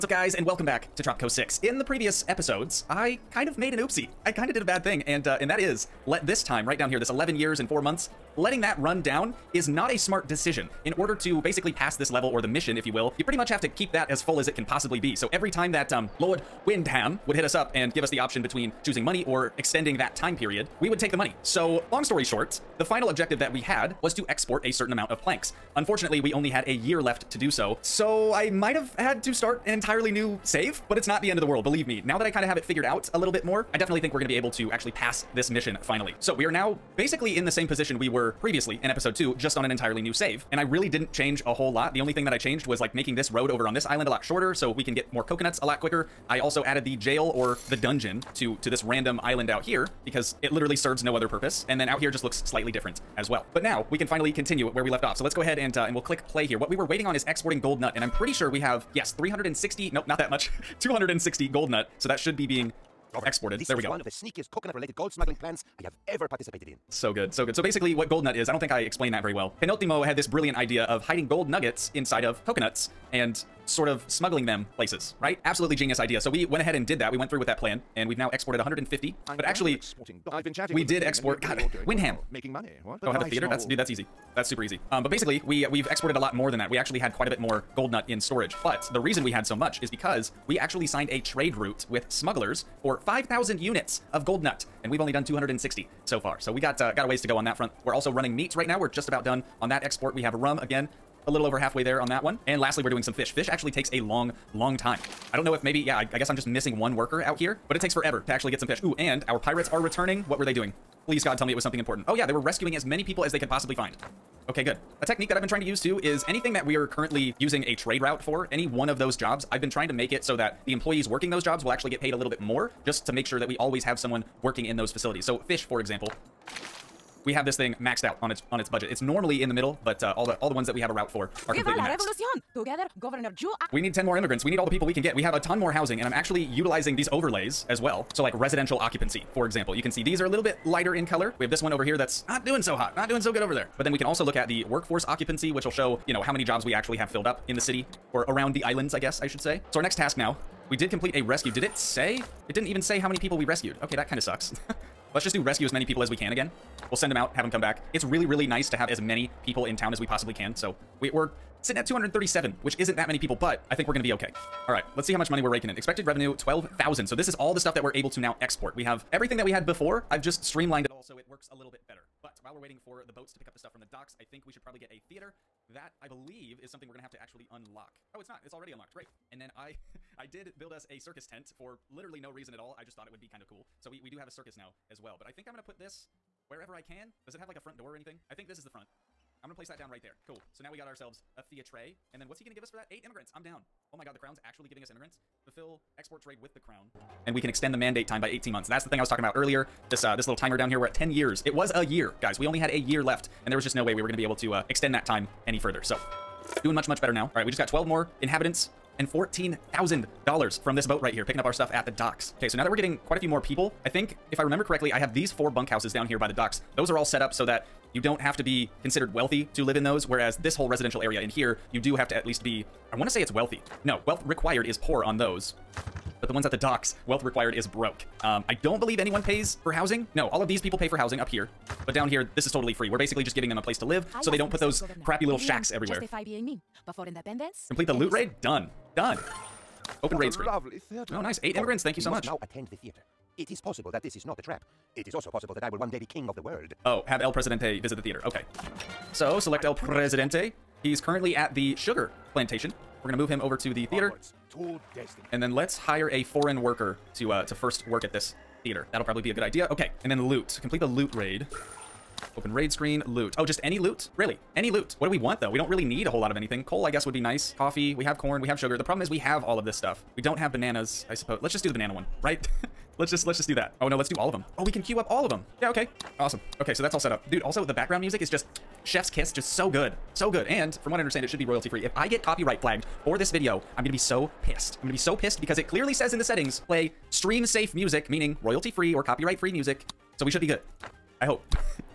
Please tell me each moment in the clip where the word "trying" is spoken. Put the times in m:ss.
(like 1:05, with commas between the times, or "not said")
1:55, 1:59.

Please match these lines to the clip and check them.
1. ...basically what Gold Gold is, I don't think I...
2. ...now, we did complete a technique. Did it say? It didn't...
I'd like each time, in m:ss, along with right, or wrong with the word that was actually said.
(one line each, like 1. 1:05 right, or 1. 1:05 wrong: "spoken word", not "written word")
1. 1:07 wrong: "Nut", not "Gold"
2. 2:30 wrong: "rescue", not "technique".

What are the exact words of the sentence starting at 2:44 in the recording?
All right, let's see how much money we're raking in.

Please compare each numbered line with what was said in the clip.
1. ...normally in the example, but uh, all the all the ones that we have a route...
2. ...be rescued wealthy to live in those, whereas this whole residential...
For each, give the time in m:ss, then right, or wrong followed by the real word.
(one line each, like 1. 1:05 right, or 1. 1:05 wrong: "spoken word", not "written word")
1. 2:09 wrong: "middle", not "example"
2. 3:38 wrong: "considered", not "rescued".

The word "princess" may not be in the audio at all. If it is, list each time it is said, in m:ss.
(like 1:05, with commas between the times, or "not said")
not said.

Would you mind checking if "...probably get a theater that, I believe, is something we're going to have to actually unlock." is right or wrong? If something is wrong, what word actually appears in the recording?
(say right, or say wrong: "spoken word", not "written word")
right.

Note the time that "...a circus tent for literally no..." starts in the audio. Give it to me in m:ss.
3:00.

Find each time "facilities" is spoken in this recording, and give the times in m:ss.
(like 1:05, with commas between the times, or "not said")
2:04.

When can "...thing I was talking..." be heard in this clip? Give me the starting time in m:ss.
3:18.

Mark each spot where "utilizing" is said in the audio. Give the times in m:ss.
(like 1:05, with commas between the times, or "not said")
2:16.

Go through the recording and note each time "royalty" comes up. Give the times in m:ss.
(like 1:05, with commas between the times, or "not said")
4:41, 4:48.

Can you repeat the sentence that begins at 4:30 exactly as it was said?
We don't have bananas, I suppose.